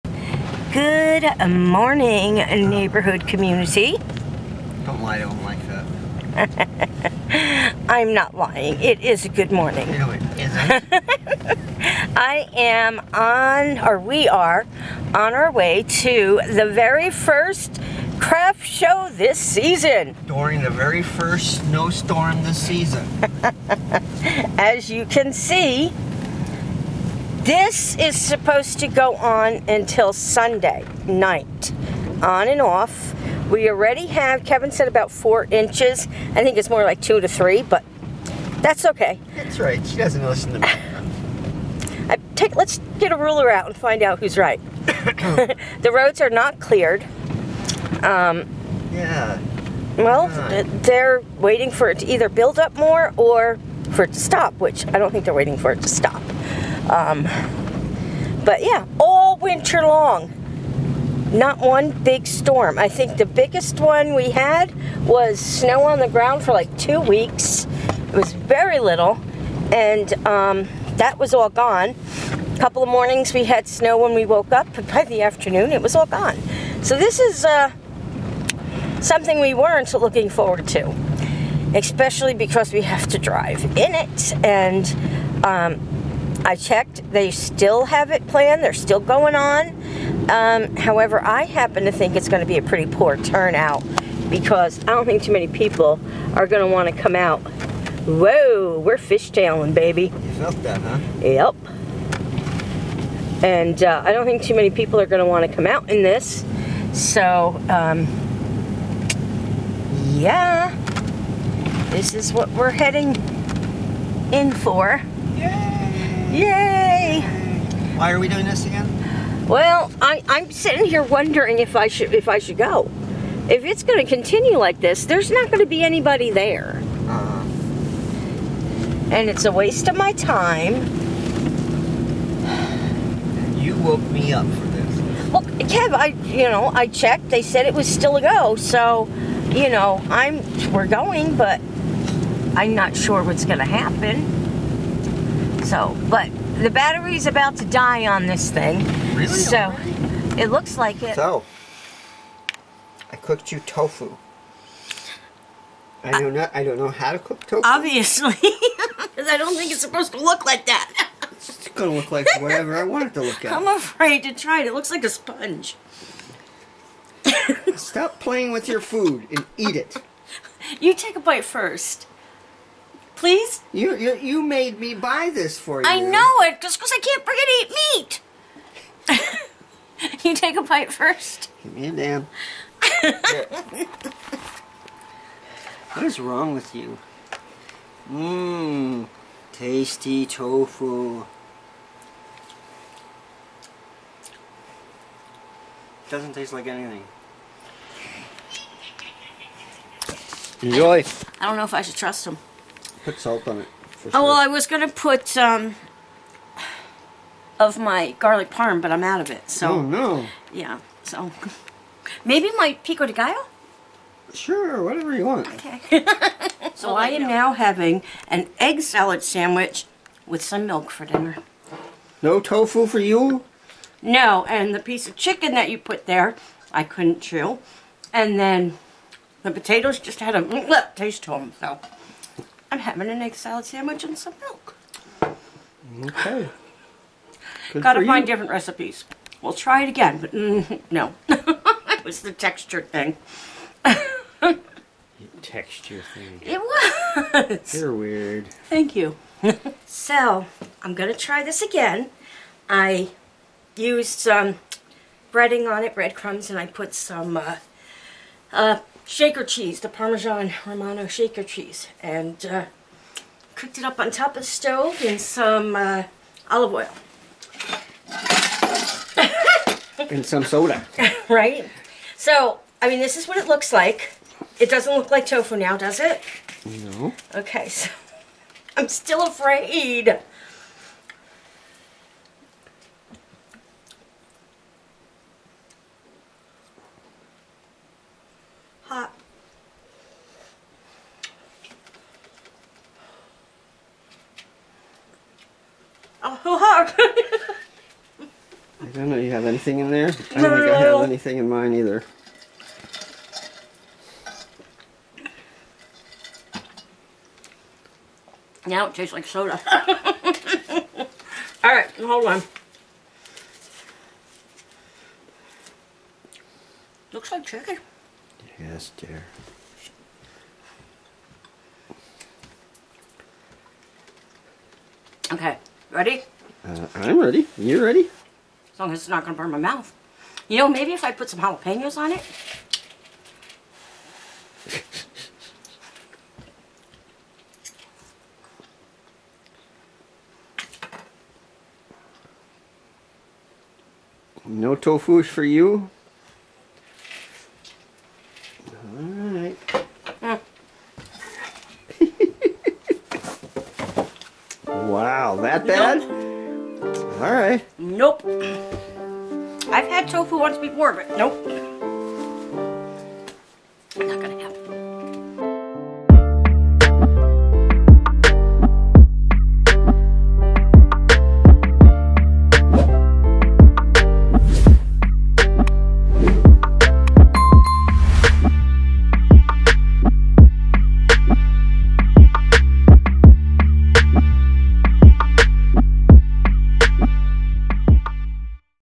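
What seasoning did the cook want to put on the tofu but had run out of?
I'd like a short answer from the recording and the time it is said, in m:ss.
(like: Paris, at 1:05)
garlic parm, at 3:28.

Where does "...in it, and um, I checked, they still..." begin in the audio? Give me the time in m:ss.
1:23.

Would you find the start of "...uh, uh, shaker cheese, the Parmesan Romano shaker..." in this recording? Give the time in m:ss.
4:17.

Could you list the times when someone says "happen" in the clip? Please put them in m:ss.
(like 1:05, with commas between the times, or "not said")
1:31, 2:23.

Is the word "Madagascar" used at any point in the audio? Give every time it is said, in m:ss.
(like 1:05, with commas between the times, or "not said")
not said.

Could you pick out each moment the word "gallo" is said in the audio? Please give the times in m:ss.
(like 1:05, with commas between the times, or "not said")
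3:33.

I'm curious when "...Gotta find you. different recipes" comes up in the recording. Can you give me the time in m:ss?
3:57.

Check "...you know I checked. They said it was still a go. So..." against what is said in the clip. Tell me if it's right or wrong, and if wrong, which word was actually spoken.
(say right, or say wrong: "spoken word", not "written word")
right.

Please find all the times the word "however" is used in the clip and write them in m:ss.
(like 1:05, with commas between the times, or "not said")
1:30.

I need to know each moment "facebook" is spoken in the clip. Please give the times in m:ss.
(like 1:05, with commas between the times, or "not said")
not said.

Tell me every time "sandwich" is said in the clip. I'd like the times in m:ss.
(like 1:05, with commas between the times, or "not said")
3:39, 3:53.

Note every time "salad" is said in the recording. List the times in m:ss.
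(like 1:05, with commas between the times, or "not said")
3:38, 3:53.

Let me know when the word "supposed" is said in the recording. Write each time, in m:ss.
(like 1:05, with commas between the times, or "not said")
0:28, 2:39.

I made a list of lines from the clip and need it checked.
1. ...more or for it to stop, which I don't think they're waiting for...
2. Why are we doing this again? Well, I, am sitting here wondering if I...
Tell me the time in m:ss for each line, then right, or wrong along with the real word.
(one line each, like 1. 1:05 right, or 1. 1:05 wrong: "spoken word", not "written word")
1. 0:52 right
2. 1:57 right.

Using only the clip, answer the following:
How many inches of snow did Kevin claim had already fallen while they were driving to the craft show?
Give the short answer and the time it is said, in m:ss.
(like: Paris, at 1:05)
4, at 0:34.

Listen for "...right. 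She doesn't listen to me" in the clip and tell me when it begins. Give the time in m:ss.
0:39.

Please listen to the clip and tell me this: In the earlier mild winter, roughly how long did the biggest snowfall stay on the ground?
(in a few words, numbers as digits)
two weeks.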